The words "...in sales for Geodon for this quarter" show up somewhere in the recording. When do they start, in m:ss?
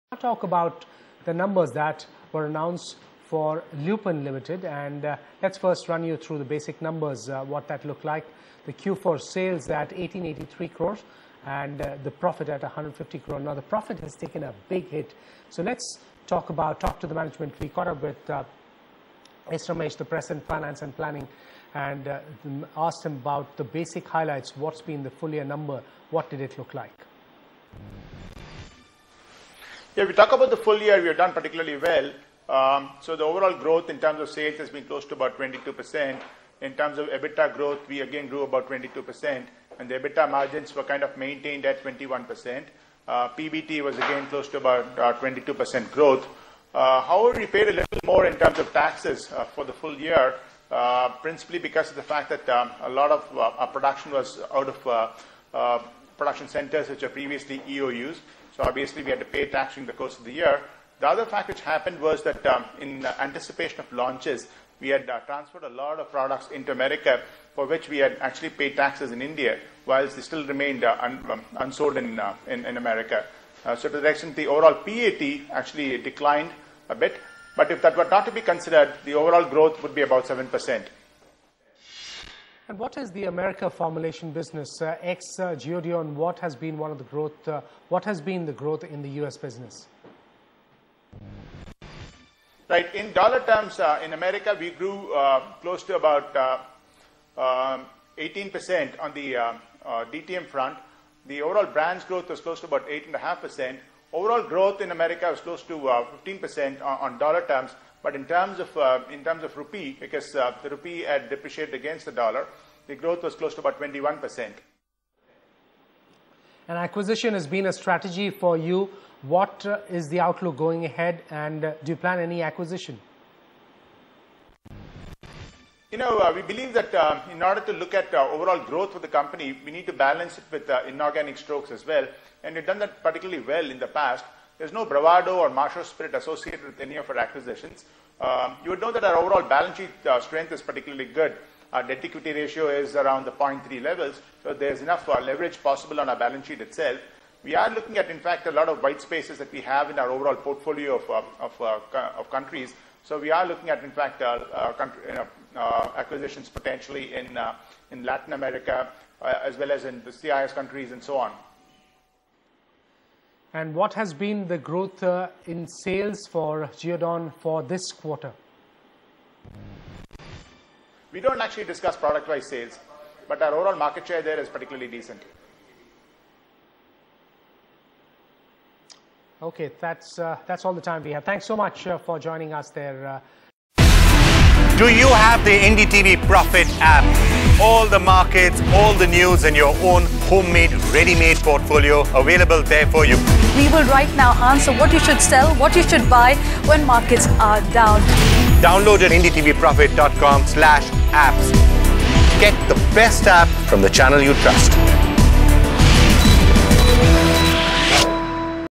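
2:45.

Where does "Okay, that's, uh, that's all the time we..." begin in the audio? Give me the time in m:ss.
2:59.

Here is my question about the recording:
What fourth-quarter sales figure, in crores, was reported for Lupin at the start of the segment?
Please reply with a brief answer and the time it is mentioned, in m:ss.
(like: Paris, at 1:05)
1883 crores, at 0:09.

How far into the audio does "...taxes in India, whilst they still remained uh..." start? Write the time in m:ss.
1:08.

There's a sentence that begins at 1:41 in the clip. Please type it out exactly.
The overall brands growth was close to about 8.5%.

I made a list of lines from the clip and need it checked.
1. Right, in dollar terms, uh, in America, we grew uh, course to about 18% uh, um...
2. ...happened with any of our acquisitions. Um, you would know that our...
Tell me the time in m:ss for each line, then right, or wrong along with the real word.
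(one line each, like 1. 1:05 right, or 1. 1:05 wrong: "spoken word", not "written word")
1. 1:32 wrong: "close", not "course"
2. 2:16 wrong: "associated", not "happened".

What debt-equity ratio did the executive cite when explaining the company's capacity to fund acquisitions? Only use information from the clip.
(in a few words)
0.3.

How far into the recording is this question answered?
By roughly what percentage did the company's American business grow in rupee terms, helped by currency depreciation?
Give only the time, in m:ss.
1:53.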